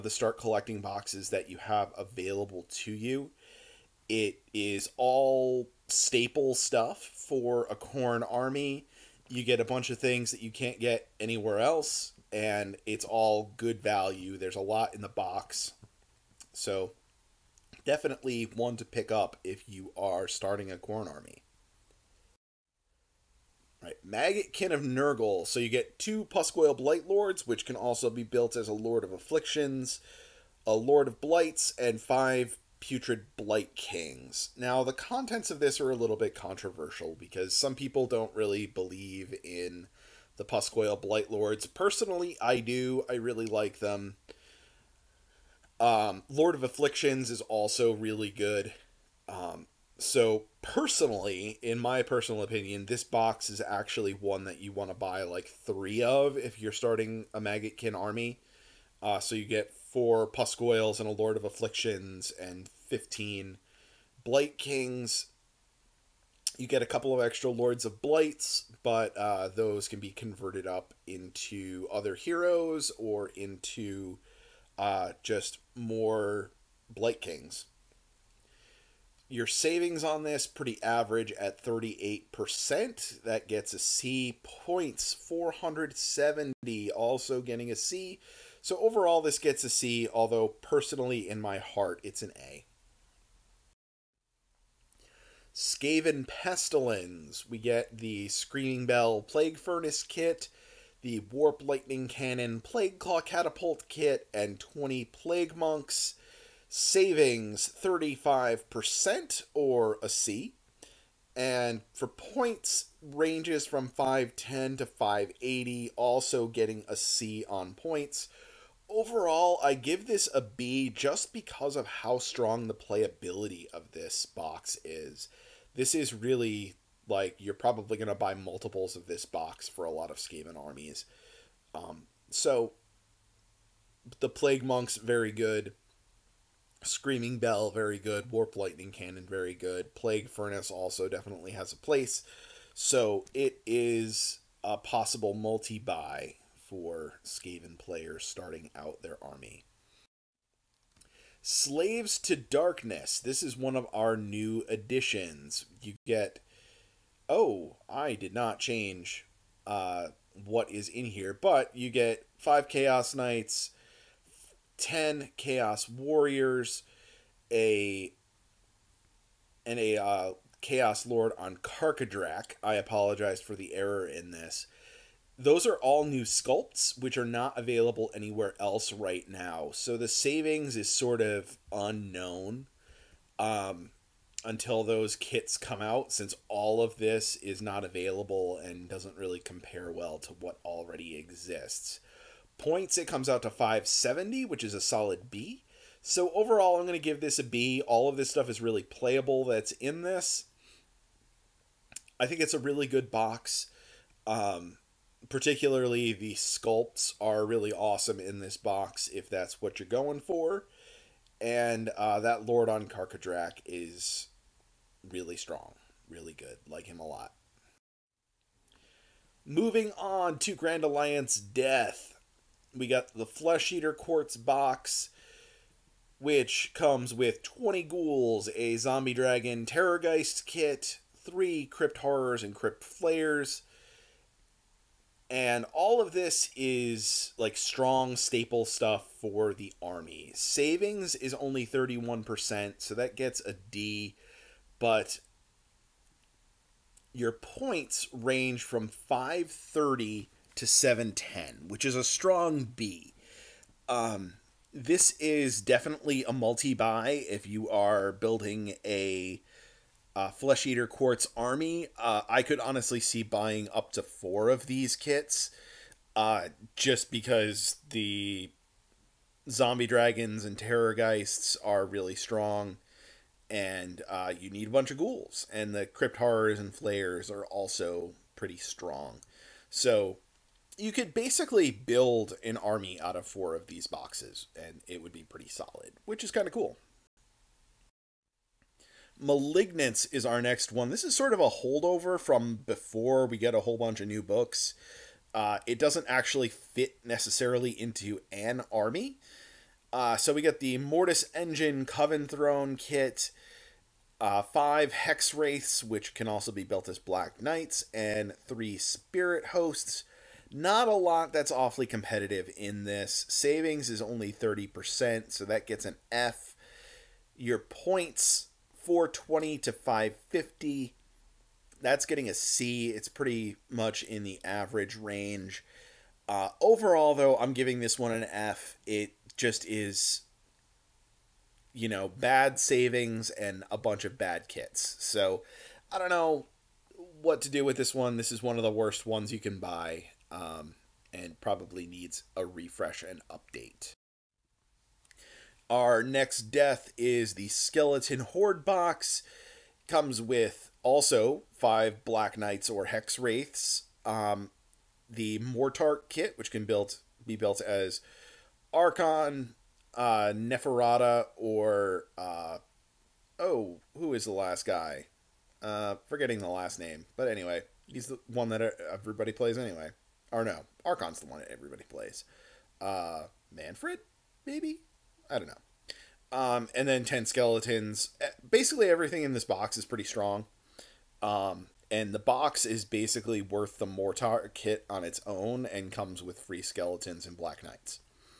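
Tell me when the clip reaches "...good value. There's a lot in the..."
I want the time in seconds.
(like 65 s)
13 s.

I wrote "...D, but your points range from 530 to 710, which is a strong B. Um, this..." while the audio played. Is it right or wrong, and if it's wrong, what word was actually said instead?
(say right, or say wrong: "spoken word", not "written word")
right.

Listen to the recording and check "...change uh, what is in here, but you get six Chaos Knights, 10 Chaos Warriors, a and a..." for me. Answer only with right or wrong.
wrong.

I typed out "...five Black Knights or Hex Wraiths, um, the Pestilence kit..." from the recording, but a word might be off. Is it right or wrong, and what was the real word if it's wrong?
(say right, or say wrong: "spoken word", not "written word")
wrong: "Mortarch", not "Pestilence".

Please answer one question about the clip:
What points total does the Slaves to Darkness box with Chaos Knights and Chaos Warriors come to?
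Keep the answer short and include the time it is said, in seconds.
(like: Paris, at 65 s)
570, at 193 s.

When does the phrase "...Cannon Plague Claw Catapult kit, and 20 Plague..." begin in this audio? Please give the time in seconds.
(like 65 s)
102 s.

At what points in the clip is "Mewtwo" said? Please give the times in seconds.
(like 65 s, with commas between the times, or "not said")
not said.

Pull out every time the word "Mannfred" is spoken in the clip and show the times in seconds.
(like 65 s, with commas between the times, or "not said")
373 s.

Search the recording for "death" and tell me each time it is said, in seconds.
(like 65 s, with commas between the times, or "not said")
221 s, 346 s.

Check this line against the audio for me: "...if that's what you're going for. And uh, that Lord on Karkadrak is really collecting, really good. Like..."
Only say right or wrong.
wrong.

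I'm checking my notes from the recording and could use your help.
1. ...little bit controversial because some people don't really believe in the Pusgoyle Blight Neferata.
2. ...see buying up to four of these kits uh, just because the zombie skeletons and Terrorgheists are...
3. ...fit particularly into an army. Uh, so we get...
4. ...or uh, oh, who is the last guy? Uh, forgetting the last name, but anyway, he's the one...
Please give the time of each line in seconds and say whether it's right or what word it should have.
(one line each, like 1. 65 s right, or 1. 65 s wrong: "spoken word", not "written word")
1. 35 s wrong: "Lords", not "Neferata"
2. 262 s wrong: "dragons", not "skeletons"
3. 296 s wrong: "necessarily", not "particularly"
4. 361 s right.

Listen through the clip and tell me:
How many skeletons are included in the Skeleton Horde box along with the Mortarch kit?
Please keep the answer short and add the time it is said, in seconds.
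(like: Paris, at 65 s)
10, at 377 s.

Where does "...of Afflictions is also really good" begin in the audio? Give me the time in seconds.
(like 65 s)
46 s.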